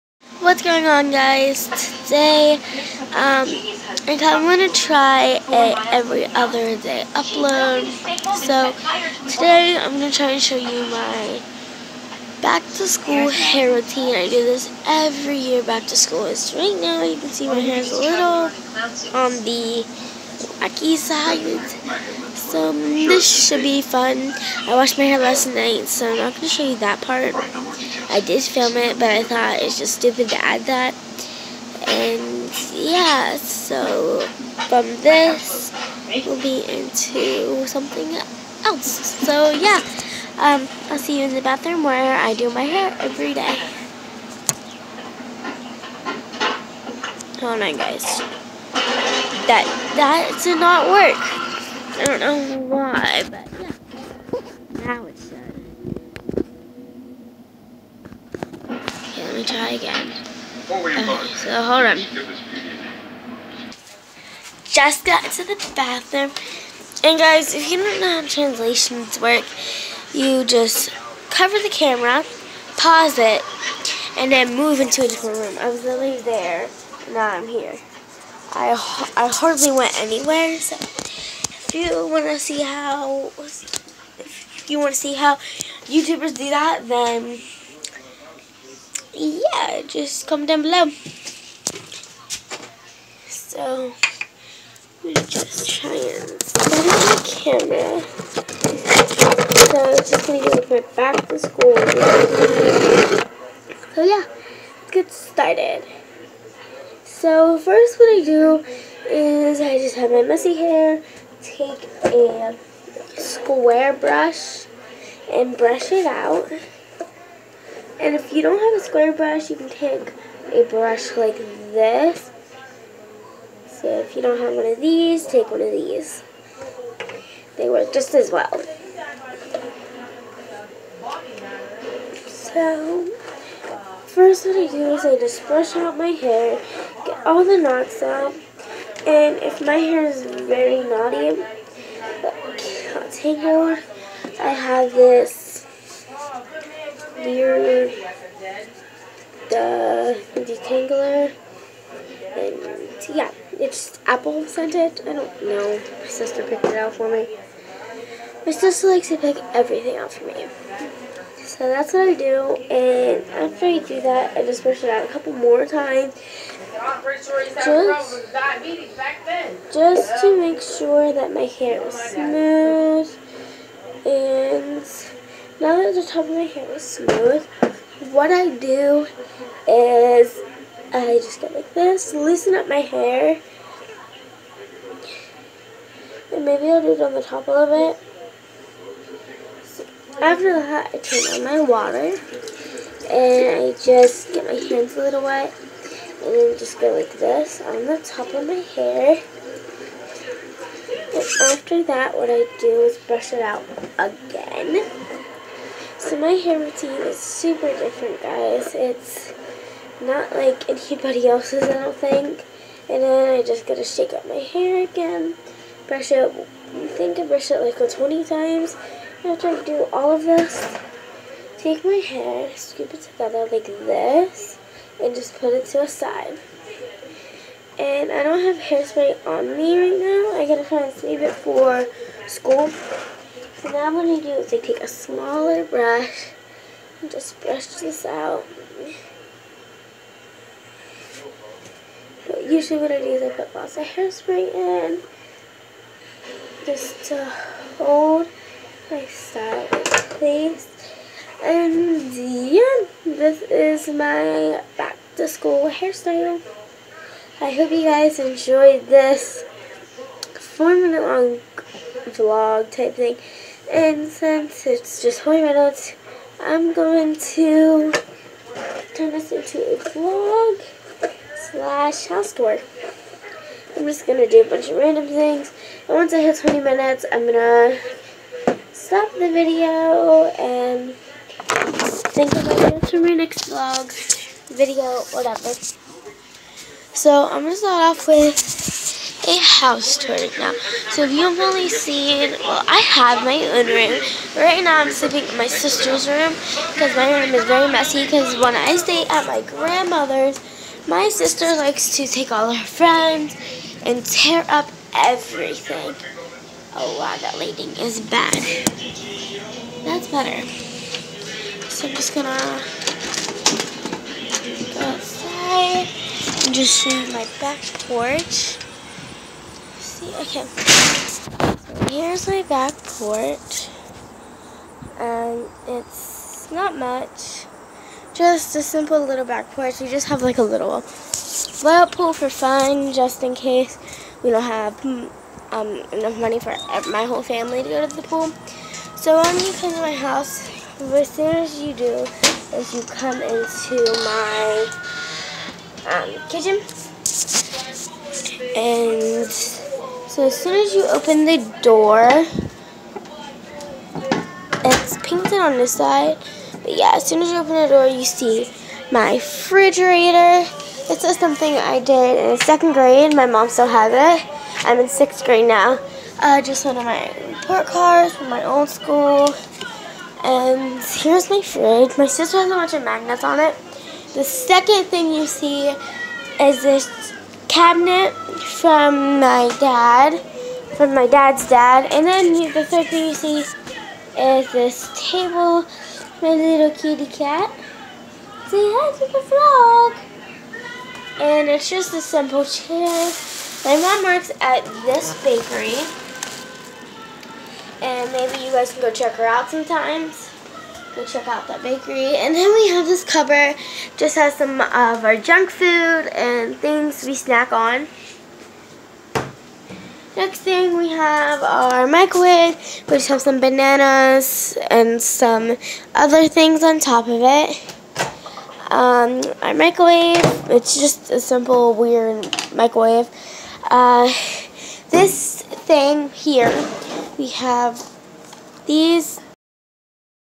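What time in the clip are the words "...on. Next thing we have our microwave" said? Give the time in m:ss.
6:47.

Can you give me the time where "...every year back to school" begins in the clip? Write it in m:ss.
0:14.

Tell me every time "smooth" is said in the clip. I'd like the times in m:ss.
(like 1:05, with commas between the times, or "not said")
2:51, 2:56.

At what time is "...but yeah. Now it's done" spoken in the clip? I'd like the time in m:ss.
0:53.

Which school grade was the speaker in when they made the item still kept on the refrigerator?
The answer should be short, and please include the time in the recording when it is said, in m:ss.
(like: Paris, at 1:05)
Second grade, at 6:02.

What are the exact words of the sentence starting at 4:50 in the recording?
So if you've only seen, well, I have my own room.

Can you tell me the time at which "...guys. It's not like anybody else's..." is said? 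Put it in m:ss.
3:28.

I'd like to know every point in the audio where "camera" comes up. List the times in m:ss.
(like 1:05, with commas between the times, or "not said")
1:11, 1:37.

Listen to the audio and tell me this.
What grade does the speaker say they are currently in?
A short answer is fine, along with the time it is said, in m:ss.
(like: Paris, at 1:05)
Sixth grade, at 6:04.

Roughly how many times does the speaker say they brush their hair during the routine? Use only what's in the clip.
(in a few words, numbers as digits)
20.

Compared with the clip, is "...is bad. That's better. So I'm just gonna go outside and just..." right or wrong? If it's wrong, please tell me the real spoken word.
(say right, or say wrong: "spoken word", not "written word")
right.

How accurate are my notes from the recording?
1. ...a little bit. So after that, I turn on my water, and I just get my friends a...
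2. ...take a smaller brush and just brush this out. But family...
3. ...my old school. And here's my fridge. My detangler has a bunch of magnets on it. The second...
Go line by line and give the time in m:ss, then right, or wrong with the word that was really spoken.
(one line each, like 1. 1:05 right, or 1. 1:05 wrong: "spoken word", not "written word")
1. 3:07 wrong: "hands", not "friends"
2. 3:54 wrong: "usually", not "family"
3. 6:08 wrong: "sister", not "detangler".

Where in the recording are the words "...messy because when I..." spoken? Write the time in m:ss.
4:57.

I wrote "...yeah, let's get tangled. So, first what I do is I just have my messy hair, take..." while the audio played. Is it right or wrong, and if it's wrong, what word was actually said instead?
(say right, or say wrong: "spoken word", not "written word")
wrong: "started", not "tangled".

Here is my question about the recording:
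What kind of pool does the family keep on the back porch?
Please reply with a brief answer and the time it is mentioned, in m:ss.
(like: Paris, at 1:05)
Little layout pool, at 5:30.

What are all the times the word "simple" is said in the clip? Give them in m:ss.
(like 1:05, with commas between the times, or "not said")
5:28, 6:31, 7:01.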